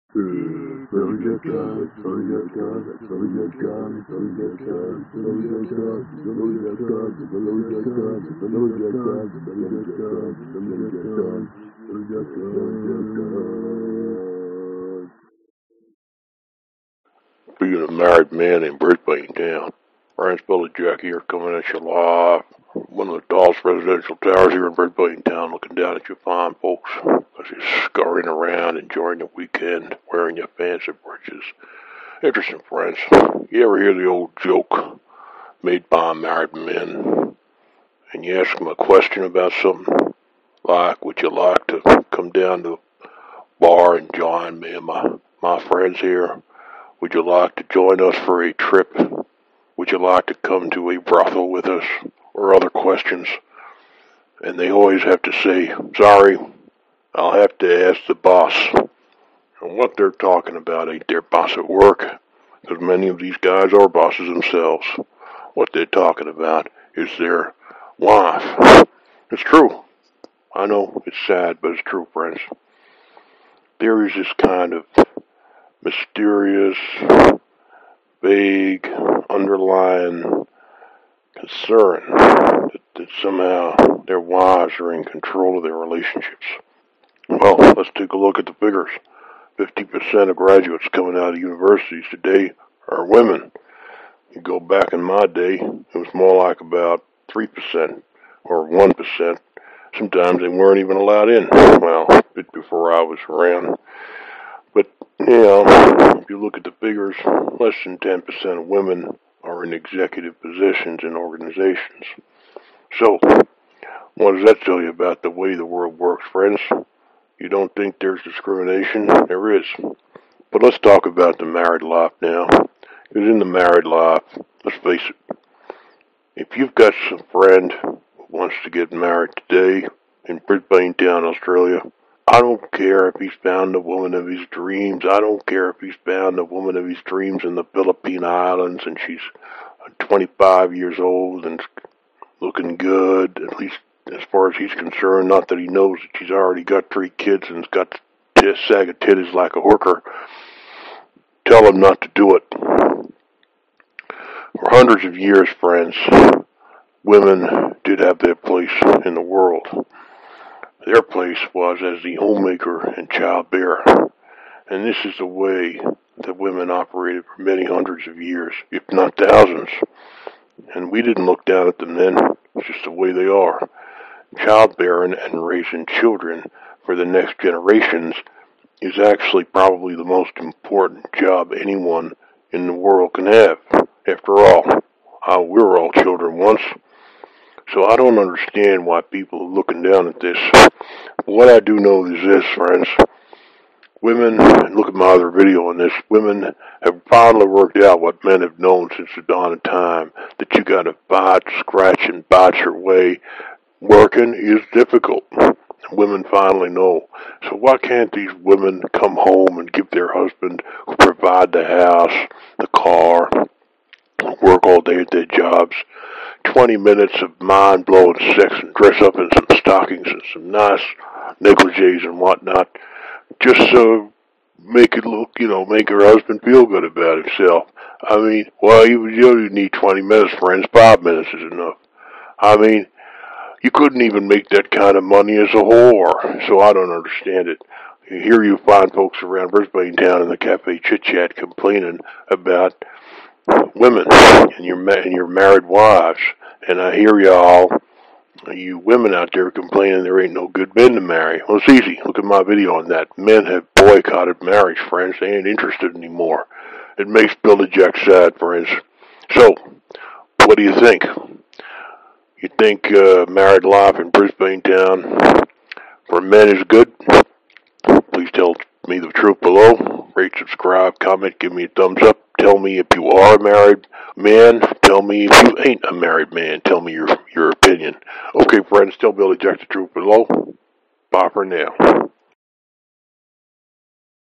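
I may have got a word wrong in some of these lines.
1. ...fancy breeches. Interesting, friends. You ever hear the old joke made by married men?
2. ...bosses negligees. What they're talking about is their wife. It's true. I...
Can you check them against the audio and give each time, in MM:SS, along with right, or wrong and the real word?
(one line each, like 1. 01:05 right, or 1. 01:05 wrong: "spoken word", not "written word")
1. 00:30 right
2. 01:03 wrong: "themselves", not "negligees".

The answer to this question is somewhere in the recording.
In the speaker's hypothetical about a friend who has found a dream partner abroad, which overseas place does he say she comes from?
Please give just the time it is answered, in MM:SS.
02:17.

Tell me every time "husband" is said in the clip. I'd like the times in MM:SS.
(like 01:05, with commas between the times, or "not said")
03:30, 03:46.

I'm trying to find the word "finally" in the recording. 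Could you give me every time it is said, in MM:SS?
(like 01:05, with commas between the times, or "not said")
03:17, 03:26.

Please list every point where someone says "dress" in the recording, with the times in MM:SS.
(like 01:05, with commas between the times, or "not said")
03:38.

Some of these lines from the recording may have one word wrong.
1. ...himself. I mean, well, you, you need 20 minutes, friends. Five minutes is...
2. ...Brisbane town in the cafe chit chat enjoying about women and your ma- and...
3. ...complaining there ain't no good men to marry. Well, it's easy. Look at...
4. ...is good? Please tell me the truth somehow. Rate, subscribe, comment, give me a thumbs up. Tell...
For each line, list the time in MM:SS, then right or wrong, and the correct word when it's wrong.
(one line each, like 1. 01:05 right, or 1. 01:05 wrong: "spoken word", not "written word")
1. 03:47 right
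2. 03:59 wrong: "complaining", not "enjoying"
3. 04:09 right
4. 04:26 wrong: "below", not "somehow".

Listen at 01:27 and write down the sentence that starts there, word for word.
Well, let's take a look at the figures.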